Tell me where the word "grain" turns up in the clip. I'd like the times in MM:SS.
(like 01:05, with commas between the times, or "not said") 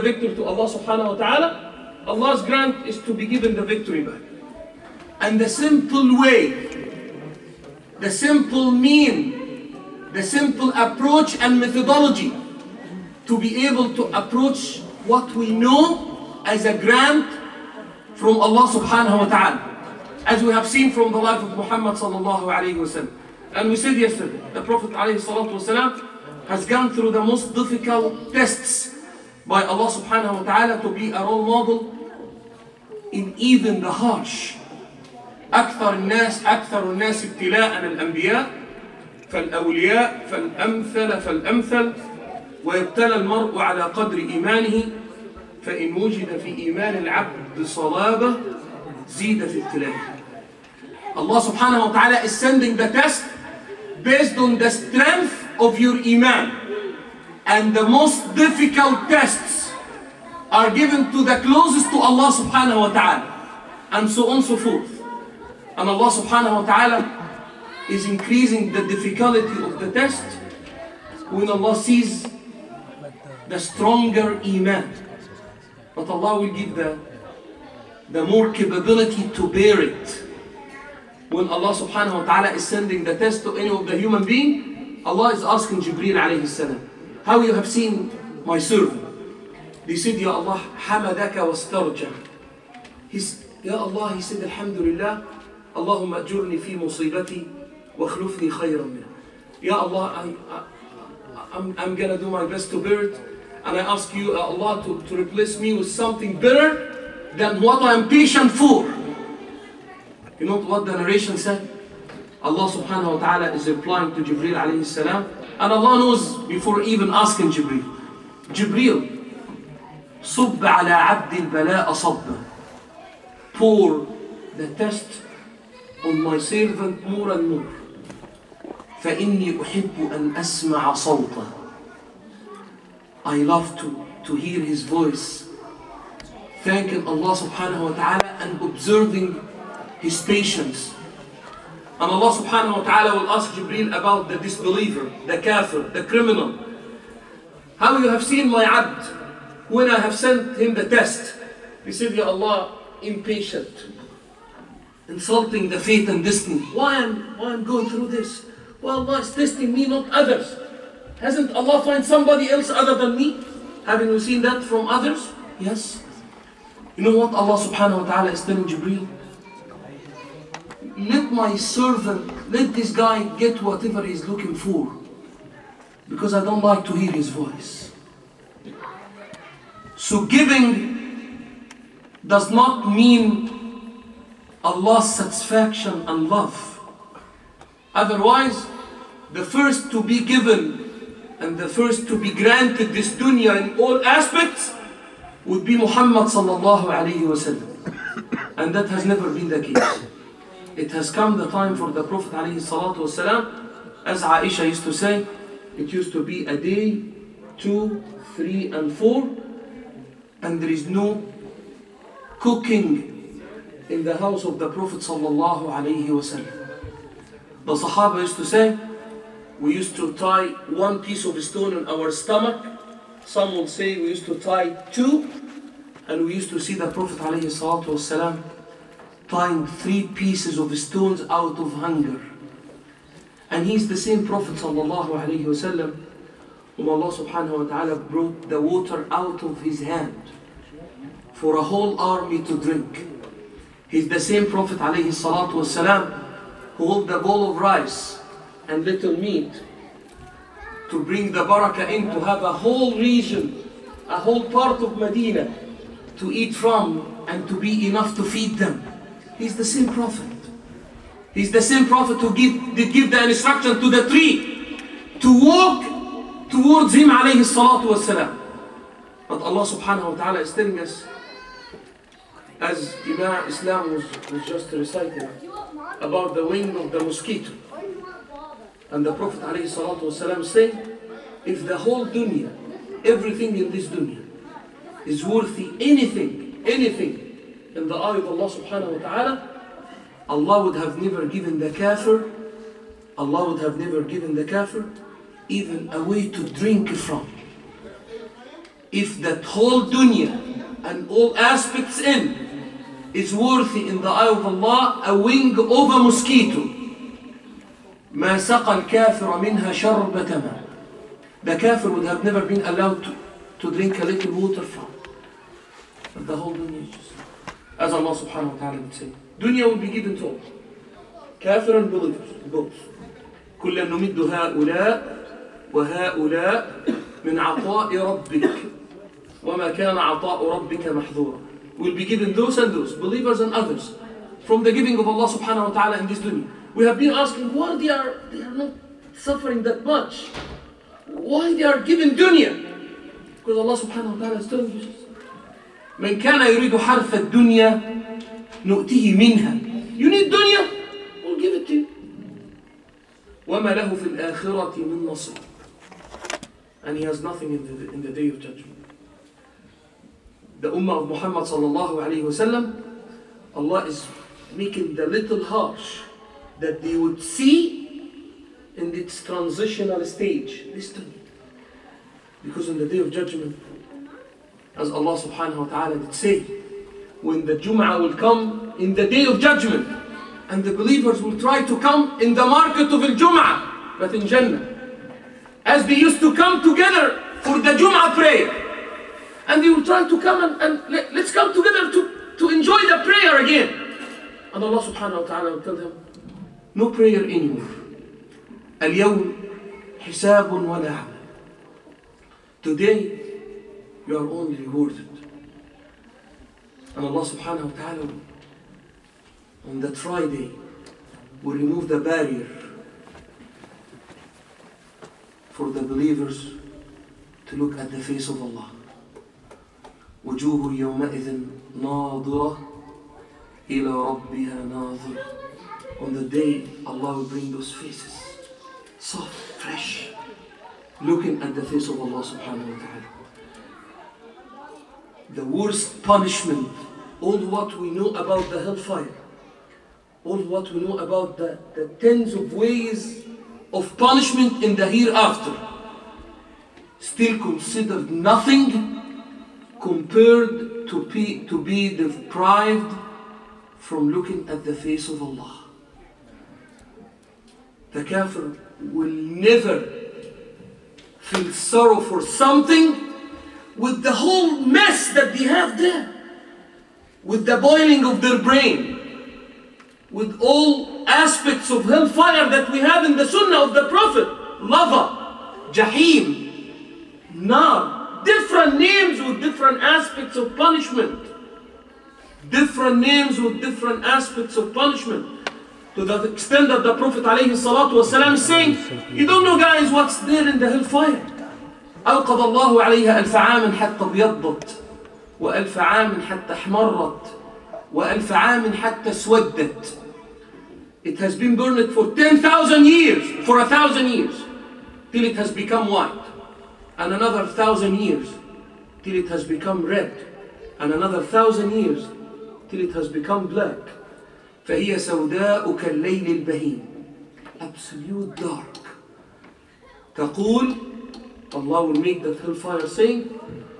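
not said.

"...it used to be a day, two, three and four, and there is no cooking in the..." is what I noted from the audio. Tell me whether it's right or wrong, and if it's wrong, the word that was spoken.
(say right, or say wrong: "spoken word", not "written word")
right.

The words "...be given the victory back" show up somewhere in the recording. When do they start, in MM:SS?
00:03.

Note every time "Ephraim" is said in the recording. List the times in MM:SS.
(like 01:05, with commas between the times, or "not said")
not said.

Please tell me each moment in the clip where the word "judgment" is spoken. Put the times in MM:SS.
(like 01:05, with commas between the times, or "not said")
05:58, 06:13, 06:19.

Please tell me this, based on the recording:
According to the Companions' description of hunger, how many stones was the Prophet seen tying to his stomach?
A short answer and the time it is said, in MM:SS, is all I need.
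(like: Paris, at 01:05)
3, at 03:49.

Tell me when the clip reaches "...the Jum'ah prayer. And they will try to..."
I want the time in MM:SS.
06:27.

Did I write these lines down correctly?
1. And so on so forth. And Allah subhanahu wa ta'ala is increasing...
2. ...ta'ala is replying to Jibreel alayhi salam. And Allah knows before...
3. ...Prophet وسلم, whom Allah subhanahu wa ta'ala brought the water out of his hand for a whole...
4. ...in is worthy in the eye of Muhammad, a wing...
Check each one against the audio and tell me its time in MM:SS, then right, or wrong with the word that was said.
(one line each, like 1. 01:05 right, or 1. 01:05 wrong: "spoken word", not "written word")
1. 01:03 right
2. 01:53 right
3. 03:54 right
4. 05:01 wrong: "Allah", not "Muhammad".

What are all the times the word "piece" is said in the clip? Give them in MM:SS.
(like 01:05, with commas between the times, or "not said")
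03:40, 03:50.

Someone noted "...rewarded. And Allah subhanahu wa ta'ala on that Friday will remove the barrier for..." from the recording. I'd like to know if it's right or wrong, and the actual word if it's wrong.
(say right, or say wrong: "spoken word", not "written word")
right.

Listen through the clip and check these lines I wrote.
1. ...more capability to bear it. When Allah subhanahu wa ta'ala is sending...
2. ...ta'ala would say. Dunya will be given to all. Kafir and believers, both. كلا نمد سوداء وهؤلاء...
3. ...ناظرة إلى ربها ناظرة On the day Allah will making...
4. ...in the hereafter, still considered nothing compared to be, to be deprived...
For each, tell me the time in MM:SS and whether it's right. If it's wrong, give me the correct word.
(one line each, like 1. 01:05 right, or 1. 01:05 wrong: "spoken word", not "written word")
1. 01:18 right
2. 05:18 wrong: "هؤلاء", not "سوداء"
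3. 07:01 wrong: "bring", not "making"
4. 07:24 right.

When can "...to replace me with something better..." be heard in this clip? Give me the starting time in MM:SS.
01:45.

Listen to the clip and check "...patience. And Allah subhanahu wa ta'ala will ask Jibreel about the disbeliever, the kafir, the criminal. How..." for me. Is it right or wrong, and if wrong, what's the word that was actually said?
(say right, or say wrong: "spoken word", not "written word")
right.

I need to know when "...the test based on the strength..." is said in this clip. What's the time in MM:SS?
00:52.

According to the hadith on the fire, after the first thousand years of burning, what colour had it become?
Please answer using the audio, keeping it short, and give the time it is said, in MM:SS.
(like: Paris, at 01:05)
White, at 08:25.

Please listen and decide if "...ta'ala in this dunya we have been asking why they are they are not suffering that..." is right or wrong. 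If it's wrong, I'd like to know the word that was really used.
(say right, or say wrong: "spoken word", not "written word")
right.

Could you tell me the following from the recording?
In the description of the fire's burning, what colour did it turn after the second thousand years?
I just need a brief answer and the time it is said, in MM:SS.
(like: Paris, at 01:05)
Red, at 08:29.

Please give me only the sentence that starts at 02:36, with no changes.
Why am, why am going through this?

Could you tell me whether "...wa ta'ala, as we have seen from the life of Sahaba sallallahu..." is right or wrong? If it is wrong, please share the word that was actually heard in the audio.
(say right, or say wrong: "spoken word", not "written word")
wrong: "Muhammad", not "Sahaba".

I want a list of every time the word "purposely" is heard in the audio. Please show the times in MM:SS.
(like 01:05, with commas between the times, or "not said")
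not said.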